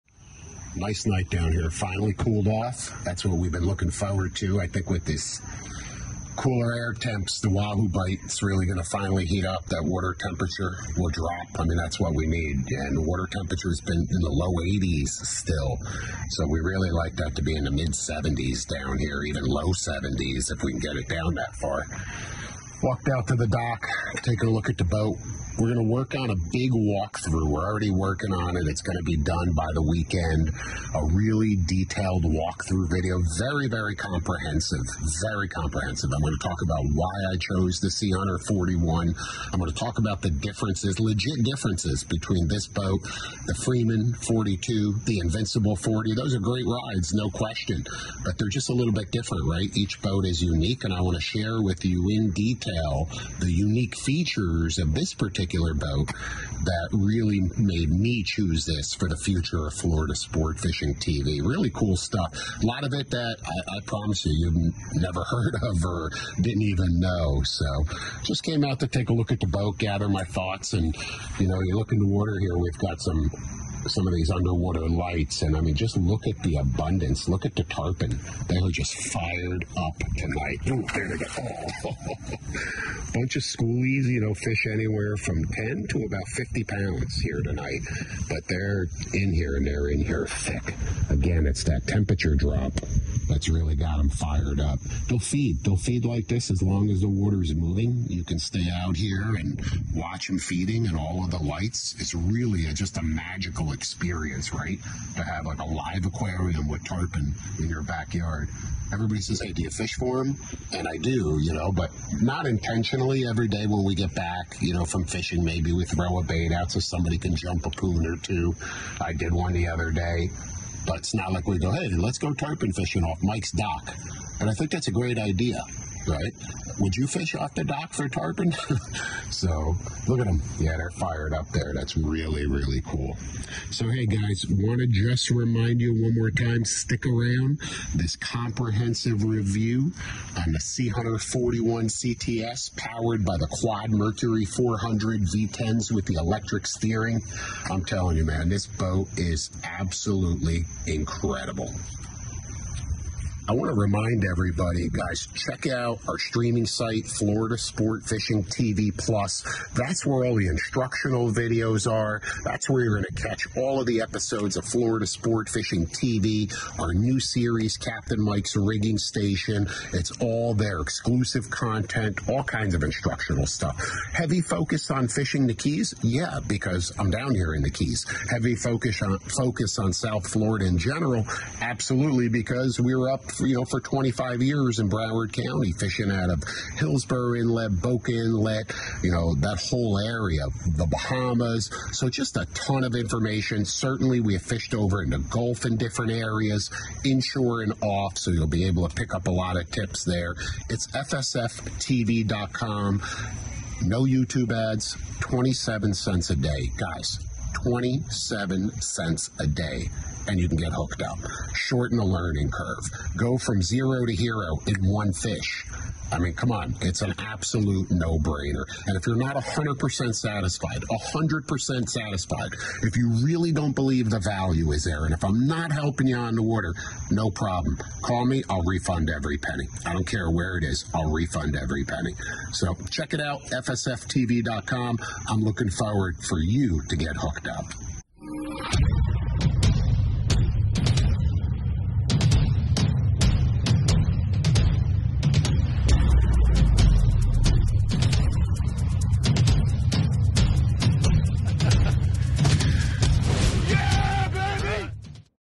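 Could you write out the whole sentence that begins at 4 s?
I think with this cooler air temps, the Wahoo bite, is really going to finally heat up.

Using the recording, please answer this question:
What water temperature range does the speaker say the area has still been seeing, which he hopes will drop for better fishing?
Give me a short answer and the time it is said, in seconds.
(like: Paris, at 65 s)
low 80s, at 14 s.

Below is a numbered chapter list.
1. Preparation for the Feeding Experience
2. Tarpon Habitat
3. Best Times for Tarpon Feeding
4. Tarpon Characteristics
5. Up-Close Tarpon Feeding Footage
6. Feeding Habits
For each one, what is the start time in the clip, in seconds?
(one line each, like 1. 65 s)
1. 205 s
2. 60 s
3. 150 s
4. 120 s
5. 240 s
6. 180 s.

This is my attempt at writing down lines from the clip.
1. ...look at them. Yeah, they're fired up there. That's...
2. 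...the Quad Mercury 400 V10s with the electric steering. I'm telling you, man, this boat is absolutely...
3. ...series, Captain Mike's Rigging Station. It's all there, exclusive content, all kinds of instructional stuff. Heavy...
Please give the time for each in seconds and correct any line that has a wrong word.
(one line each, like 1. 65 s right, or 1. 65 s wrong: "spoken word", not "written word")
1. 130 s right
2. 143 s right
3. 167 s right.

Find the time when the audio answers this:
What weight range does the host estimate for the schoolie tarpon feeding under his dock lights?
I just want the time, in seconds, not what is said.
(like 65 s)
85 s.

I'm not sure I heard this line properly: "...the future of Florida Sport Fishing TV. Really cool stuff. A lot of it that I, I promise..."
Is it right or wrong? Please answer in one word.
right.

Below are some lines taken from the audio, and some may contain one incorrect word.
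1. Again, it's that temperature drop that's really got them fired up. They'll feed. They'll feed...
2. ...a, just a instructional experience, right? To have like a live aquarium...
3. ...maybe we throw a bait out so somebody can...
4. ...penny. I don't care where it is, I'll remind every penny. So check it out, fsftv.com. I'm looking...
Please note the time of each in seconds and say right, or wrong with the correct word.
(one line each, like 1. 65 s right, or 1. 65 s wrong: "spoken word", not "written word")
1. 91 s right
2. 102 s wrong: "magical", not "instructional"
3. 115 s right
4. 229 s wrong: "refund", not "remind".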